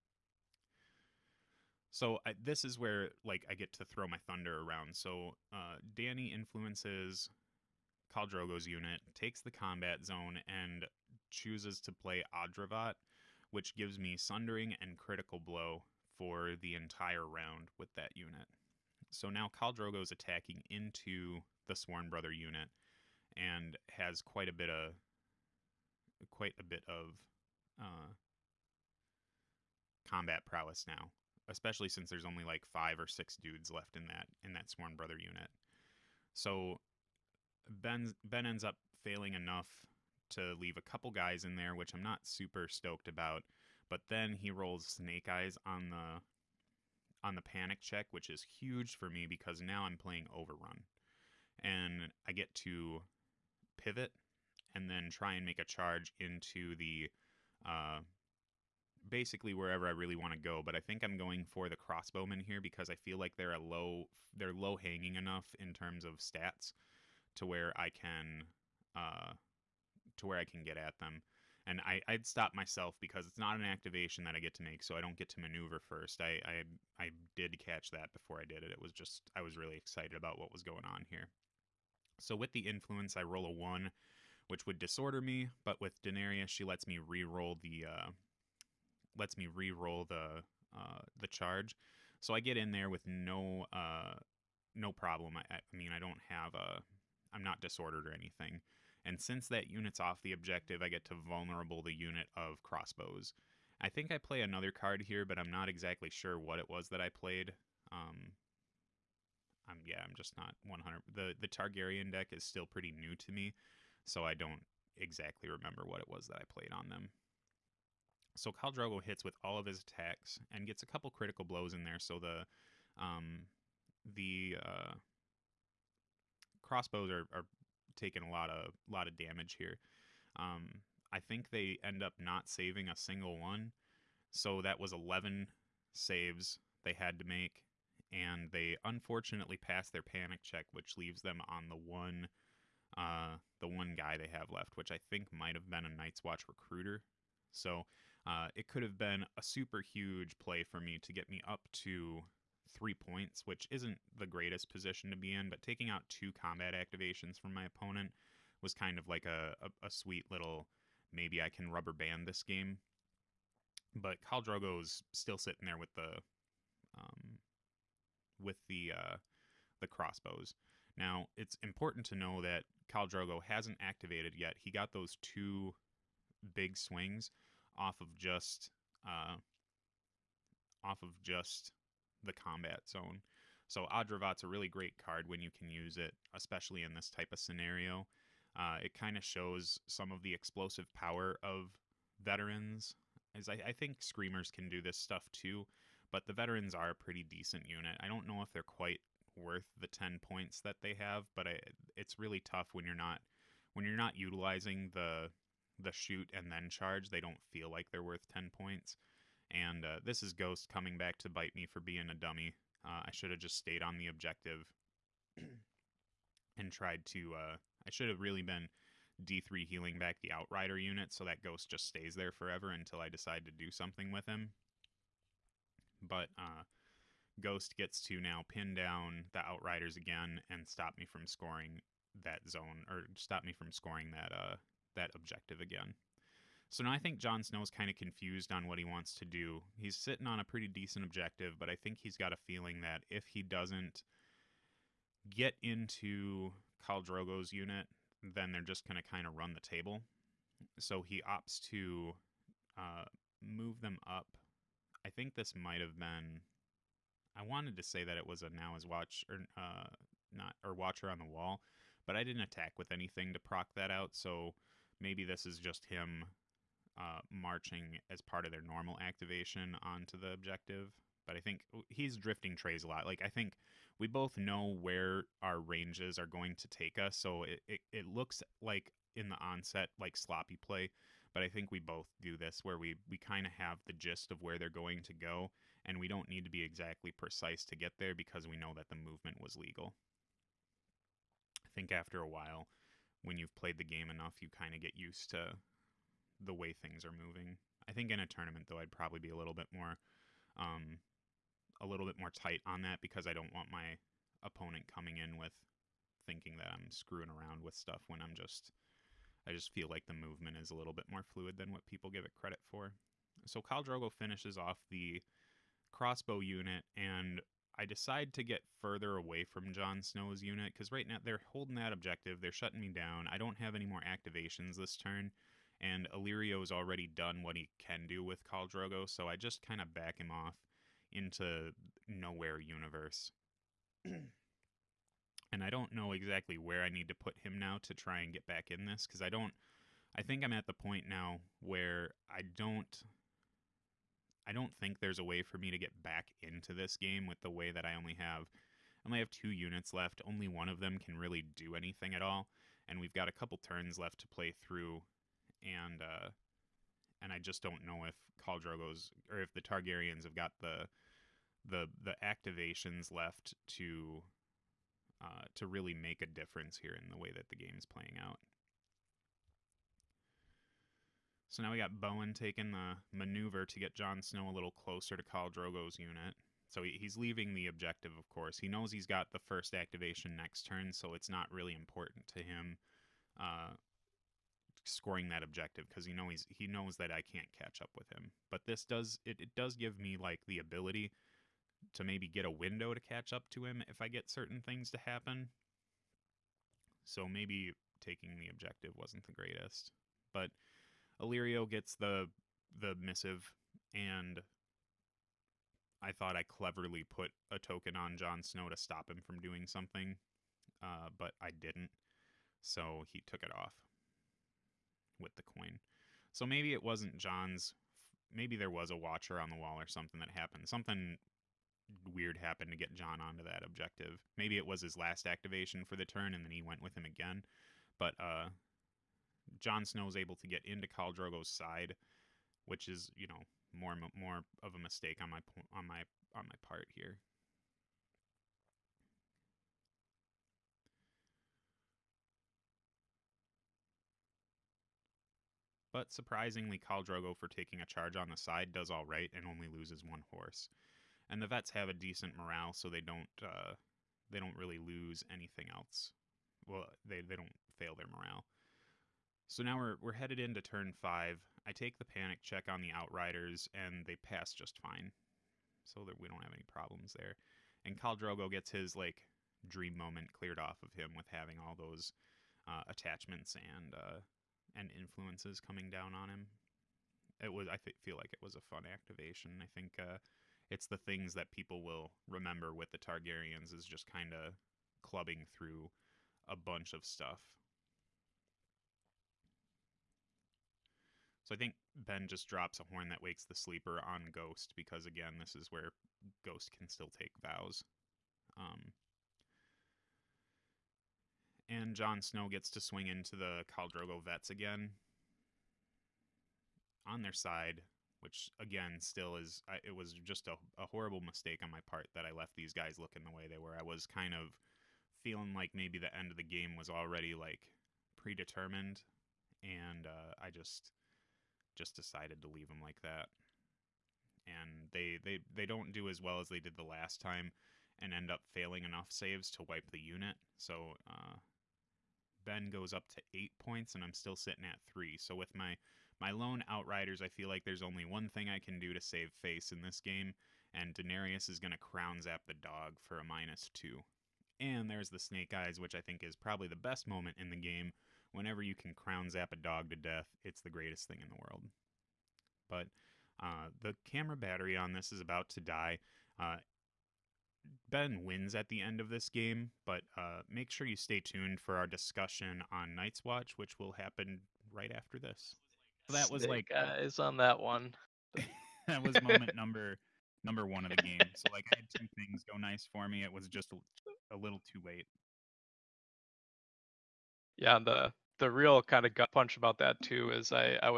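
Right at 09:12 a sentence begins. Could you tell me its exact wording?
But uh, the camera battery on this is about to die.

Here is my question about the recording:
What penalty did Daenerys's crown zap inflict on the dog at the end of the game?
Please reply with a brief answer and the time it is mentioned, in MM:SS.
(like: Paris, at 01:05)
Minus 2, at 09:03.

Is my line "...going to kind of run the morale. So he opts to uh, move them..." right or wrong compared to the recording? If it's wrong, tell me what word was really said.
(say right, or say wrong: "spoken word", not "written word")
wrong: "table", not "morale".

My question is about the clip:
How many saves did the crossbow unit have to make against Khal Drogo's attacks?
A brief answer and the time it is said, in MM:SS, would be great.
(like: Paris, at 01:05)
11, at 02:14.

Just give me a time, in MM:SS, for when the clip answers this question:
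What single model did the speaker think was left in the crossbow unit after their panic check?
02:25.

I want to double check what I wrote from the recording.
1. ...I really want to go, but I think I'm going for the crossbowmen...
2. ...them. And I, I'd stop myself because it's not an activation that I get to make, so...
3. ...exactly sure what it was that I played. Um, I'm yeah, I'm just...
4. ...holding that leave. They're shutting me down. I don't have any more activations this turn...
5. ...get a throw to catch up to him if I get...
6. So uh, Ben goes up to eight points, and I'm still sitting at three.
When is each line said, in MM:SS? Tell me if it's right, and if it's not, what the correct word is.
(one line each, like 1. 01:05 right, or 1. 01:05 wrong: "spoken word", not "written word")
1. 00:59 right
2. 01:10 right
3. 01:45 right
4. 05:21 wrong: "objective", not "leave"
5. 06:32 wrong: "window", not "throw"
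6. 08:50 right.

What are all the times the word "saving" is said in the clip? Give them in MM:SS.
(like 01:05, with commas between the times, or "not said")
02:12.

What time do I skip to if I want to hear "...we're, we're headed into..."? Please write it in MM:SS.
07:39.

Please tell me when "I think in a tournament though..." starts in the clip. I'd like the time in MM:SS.
04:57.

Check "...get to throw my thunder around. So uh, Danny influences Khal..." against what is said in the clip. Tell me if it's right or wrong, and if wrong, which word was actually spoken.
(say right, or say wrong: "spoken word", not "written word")
right.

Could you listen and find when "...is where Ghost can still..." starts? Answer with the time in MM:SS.
08:15.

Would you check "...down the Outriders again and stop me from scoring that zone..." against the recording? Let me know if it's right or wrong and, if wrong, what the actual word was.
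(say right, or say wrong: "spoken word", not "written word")
right.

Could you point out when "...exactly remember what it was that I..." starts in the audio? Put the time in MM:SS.
01:54.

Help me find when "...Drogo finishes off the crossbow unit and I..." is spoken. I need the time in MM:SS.
05:13.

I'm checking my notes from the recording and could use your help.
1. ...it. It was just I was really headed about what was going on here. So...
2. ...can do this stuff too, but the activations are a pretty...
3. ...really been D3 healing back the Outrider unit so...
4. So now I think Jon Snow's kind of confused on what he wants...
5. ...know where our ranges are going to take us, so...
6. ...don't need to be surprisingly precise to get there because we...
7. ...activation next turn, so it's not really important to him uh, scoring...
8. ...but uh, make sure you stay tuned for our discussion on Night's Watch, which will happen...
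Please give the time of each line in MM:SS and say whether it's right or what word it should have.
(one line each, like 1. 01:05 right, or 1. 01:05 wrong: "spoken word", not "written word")
1. 01:18 wrong: "excited", not "headed"
2. 03:14 wrong: "veterans", not "activations"
3. 03:38 right
4. 03:56 right
5. 04:34 right
6. 04:46 wrong: "exactly", not "surprisingly"
7. 06:19 right
8. 09:19 right.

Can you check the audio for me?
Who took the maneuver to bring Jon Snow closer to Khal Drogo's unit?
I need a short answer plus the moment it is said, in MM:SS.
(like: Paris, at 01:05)
Bowen, at 06:11.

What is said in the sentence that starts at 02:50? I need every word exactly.
Now it's important to know that Khal Drogo hasn't activated yet.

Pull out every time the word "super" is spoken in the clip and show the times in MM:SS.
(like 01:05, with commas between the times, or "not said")
00:42, 02:29.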